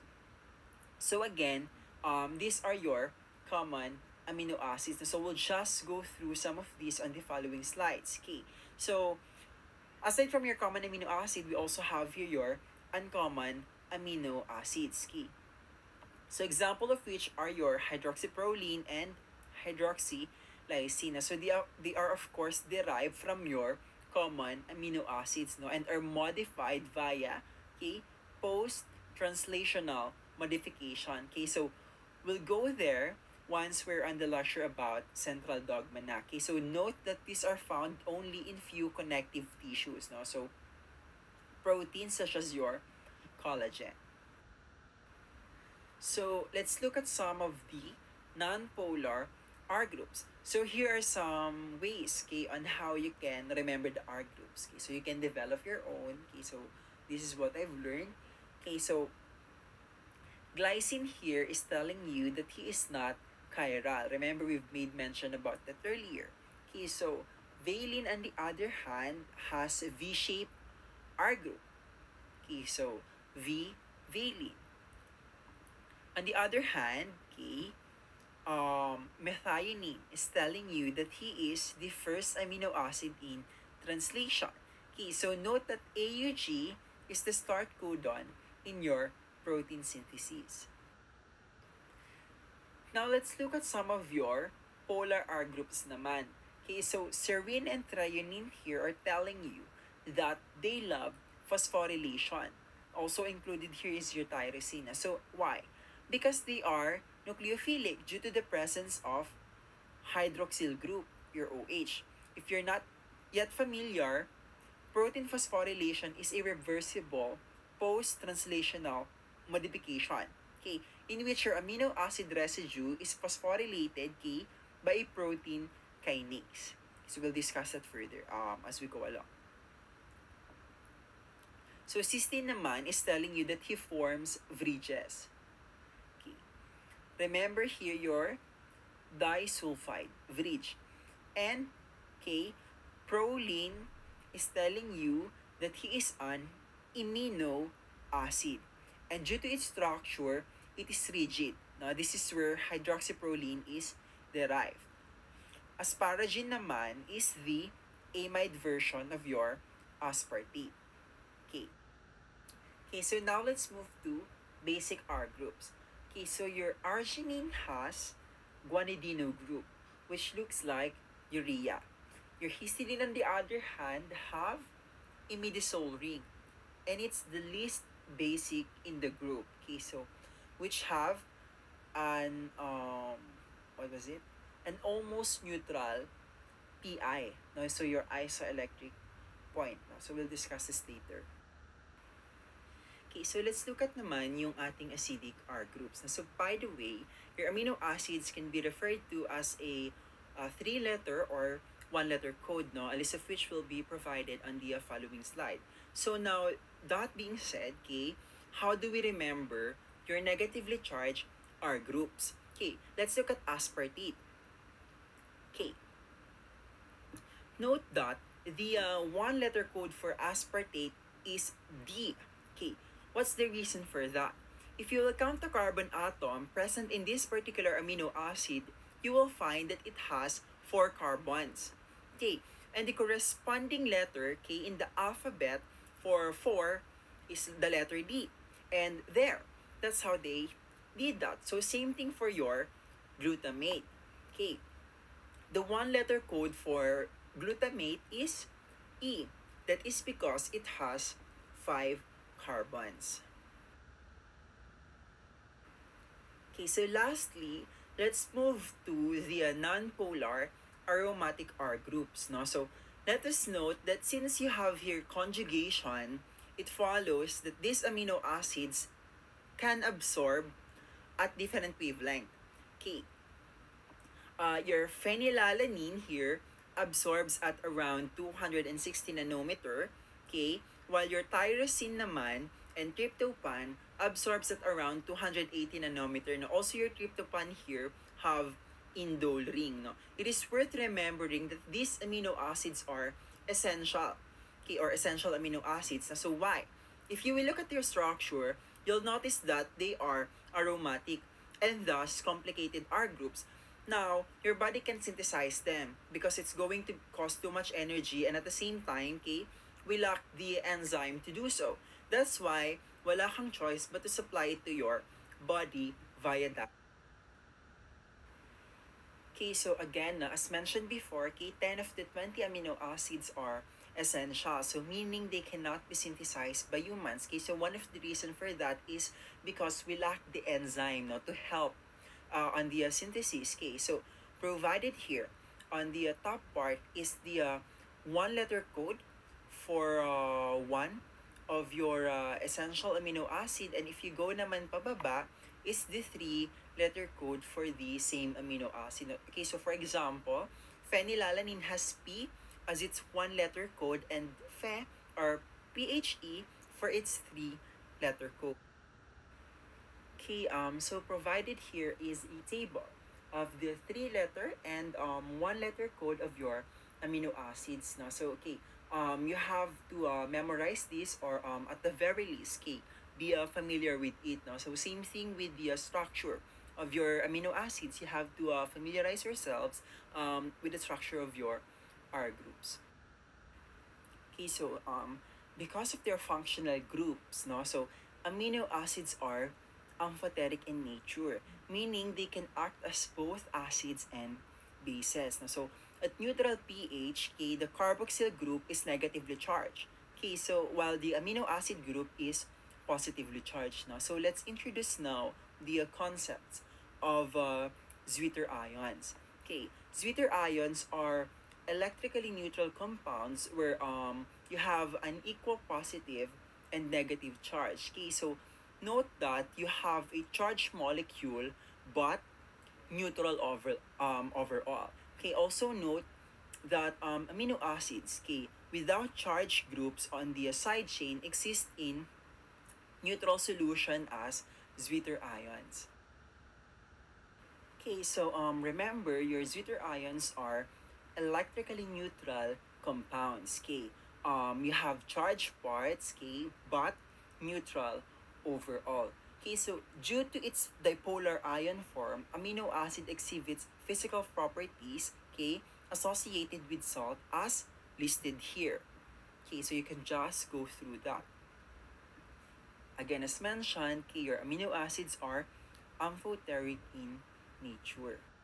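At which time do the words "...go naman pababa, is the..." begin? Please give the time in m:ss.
5:44.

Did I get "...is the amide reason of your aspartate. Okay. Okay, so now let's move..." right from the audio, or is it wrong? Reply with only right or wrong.
wrong.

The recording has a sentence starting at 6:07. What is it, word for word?
Now, so, okay, um, you have to uh, memorize this or um, at the very least, okay, be uh, familiar with it.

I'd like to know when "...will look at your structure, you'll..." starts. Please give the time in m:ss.
4:57.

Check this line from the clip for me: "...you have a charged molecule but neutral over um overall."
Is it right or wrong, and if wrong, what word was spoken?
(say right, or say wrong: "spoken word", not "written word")
right.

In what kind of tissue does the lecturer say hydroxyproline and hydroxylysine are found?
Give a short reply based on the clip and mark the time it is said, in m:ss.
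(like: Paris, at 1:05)
connective tissues, at 0:38.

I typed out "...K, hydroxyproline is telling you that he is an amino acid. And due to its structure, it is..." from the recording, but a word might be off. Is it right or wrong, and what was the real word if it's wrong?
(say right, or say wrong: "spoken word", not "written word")
wrong: "proline", not "hydroxyproline".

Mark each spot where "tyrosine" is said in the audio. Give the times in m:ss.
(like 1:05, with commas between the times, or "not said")
1:44, 4:41.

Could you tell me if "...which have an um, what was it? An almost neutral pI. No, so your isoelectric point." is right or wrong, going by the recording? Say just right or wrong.
right.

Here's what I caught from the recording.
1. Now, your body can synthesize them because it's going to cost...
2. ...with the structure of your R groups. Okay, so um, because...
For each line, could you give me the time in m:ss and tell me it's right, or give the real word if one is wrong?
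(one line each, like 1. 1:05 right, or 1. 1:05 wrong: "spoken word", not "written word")
1. 5:03 right
2. 6:20 right.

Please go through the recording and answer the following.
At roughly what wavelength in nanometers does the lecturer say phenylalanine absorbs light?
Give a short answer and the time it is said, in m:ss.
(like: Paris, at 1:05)
260 nanometers, at 4:38.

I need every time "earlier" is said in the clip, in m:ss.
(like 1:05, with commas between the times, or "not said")
1:05.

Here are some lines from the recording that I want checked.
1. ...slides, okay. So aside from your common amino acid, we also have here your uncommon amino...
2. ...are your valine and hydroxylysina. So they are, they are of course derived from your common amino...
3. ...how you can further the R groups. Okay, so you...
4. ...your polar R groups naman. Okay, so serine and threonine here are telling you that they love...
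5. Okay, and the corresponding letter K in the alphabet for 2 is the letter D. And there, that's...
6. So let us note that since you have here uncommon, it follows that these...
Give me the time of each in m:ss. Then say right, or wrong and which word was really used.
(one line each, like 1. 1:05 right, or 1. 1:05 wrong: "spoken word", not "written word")
1. 0:07 right
2. 0:17 wrong: "hydroxyproline", not "valine"
3. 0:52 wrong: "remember", not "further"
4. 1:34 right
5. 3:52 wrong: "4", not "2"
6. 4:22 wrong: "conjugation", not "uncommon".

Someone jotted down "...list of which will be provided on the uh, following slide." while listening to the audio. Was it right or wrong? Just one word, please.
right.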